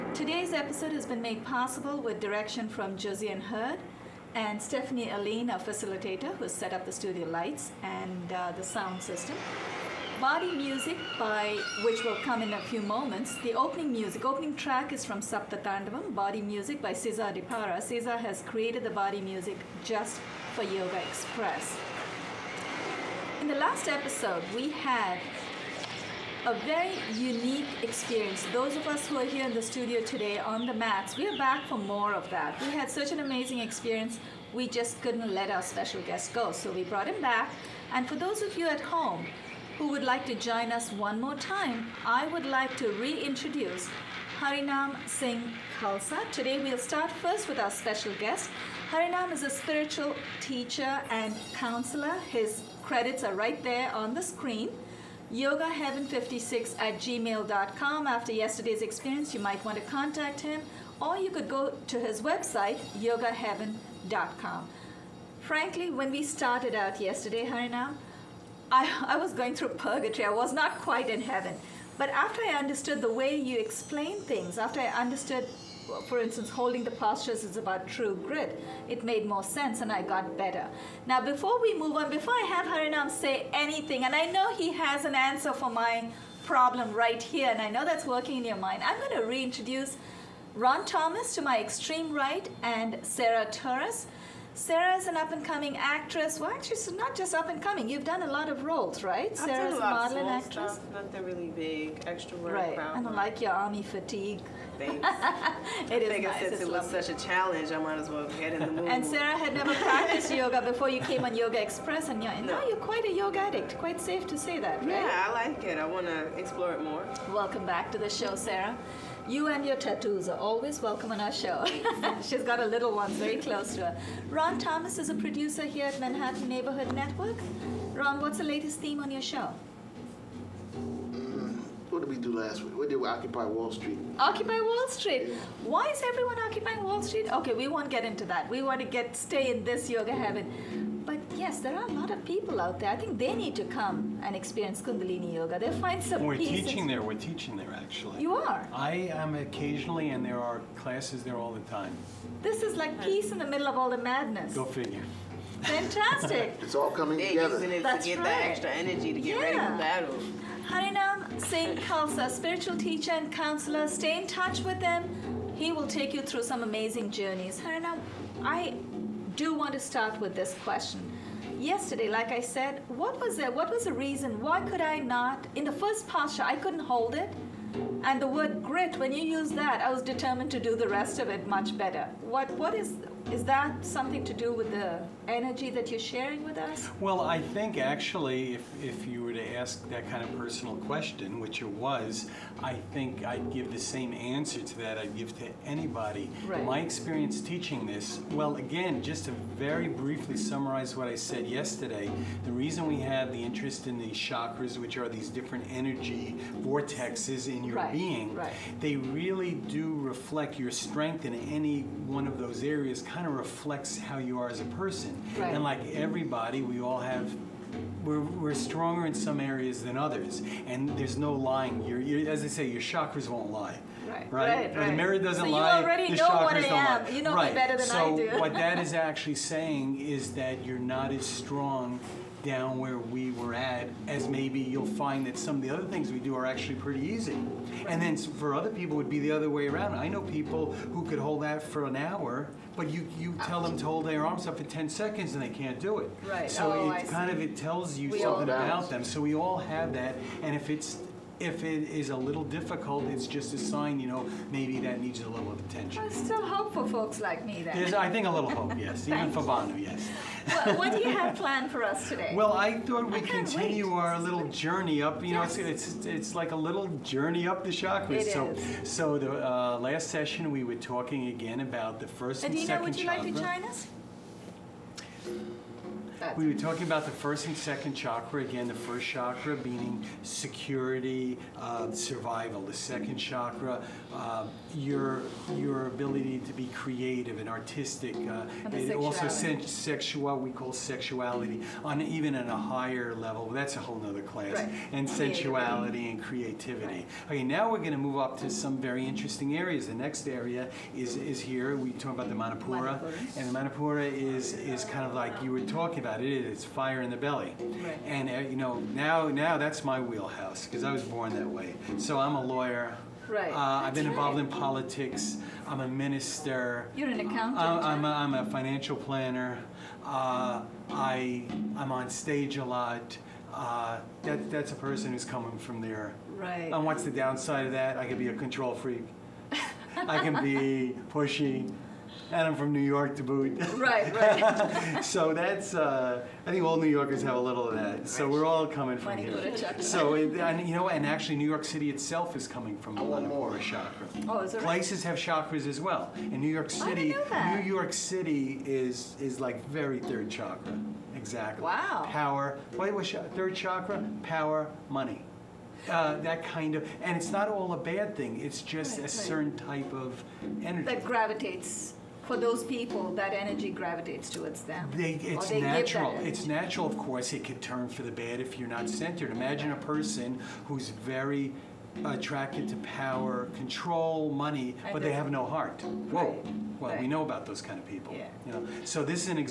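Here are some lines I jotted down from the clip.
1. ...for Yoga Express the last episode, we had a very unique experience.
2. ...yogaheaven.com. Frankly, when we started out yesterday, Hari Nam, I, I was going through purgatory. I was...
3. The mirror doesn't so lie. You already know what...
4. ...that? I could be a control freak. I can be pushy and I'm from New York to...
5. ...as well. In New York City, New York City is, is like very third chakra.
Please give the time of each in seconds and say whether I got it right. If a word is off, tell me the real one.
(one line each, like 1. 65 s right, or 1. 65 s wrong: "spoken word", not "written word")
1. 20 s right
2. 63 s right
3. 224 s right
4. 327 s right
5. 345 s right.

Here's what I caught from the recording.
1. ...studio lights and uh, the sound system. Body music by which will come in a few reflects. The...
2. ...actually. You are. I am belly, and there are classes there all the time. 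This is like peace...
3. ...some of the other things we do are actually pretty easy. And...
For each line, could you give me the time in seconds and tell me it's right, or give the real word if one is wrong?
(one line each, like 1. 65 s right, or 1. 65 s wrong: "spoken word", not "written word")
1. 6 s wrong: "moments", not "reflects"
2. 147 s wrong: "occasionally", not "belly"
3. 235 s right.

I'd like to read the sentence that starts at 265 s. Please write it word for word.
know, it's, it's, it's like a little journey up the chakras.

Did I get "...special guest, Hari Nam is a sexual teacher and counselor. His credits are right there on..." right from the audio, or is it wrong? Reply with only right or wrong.
wrong.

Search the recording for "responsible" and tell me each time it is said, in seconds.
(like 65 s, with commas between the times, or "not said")
not said.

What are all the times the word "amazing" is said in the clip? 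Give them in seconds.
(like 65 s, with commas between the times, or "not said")
33 s, 166 s.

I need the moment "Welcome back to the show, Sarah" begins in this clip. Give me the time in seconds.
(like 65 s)
117 s.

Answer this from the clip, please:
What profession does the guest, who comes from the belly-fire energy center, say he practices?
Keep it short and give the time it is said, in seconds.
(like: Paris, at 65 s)
lawyer, at 312 s.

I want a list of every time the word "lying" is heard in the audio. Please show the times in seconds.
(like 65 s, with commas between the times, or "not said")
221 s.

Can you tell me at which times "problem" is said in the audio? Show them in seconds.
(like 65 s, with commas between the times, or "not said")
86 s.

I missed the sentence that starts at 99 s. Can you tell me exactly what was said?
I've Sarah's a model and actress.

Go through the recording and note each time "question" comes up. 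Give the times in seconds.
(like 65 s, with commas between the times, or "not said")
170 s, 190 s.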